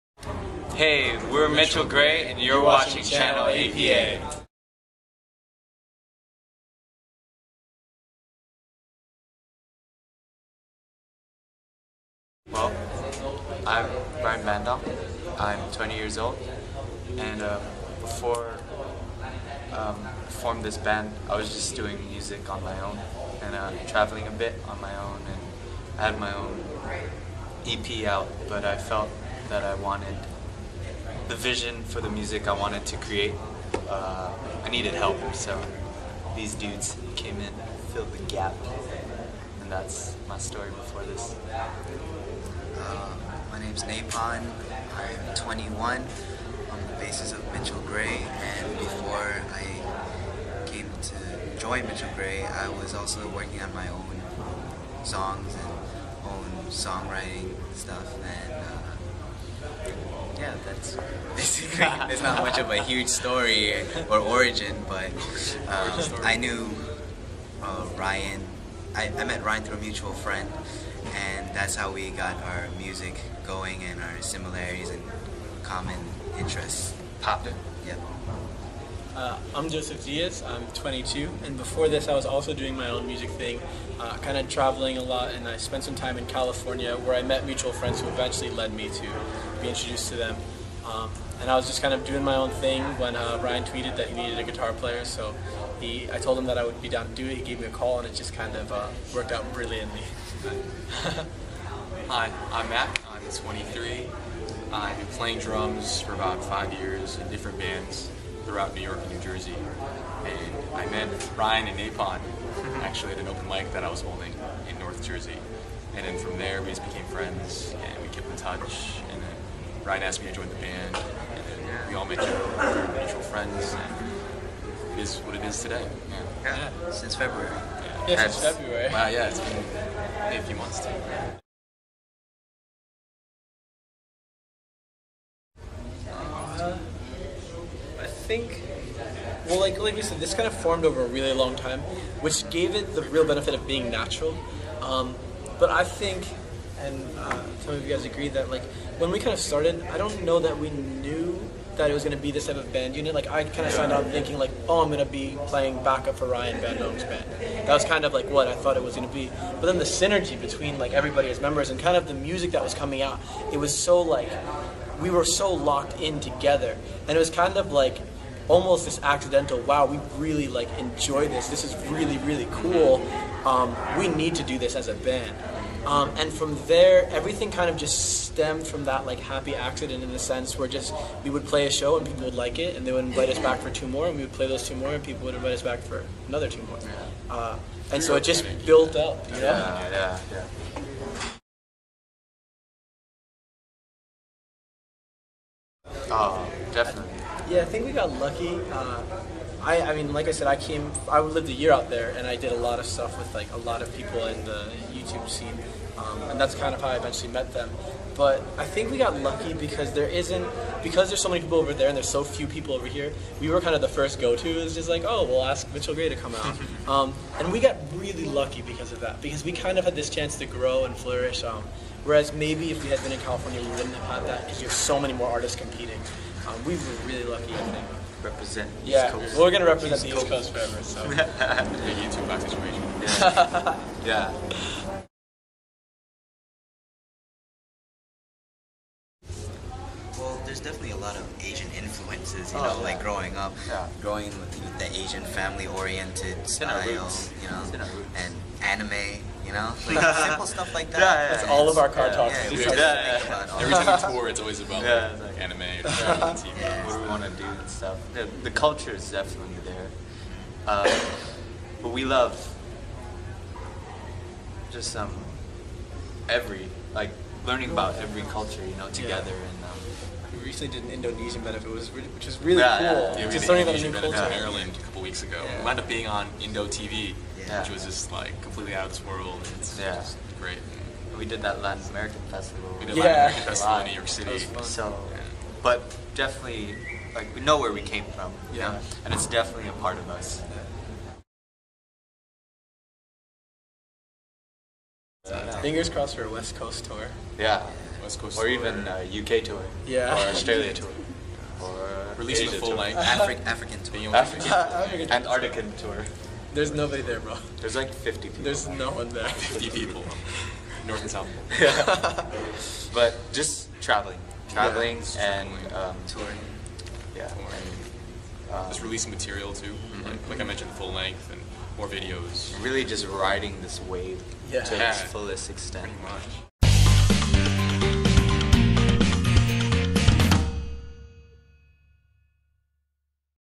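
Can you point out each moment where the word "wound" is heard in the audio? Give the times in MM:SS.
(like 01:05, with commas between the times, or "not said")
04:35.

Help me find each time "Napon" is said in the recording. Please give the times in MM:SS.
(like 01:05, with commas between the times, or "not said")
00:43, 01:51.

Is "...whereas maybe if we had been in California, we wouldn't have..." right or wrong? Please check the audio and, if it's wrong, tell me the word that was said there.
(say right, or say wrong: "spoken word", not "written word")
right.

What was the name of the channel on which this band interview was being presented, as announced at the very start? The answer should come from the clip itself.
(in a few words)
Channel APA.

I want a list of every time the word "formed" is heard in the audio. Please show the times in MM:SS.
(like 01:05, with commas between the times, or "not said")
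00:20, 02:20.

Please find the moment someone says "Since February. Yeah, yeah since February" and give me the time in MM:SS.
02:06.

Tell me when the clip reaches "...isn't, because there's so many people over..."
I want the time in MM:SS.
03:30.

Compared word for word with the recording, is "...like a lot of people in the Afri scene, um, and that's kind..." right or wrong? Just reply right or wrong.
wrong.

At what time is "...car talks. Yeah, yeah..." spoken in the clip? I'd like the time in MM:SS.
04:11.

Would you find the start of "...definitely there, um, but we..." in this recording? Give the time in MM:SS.
04:19.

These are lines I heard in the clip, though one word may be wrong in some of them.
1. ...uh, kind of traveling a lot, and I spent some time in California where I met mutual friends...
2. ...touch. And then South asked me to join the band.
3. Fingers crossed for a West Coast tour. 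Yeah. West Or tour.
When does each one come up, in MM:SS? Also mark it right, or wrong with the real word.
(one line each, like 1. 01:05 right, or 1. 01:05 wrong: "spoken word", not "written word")
1. 01:23 right
2. 01:58 wrong: "Ryan", not "South"
3. 04:55 right.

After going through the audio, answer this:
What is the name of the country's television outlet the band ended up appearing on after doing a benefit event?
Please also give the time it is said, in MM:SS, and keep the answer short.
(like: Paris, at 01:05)
Indo TV, at 04:36.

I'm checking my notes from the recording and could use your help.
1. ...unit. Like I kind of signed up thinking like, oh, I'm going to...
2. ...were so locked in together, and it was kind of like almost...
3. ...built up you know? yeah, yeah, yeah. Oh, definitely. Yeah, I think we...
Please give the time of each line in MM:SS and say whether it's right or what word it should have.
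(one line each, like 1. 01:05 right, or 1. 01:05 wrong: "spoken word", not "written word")
1. 02:32 right
2. 02:45 right
3. 03:08 right.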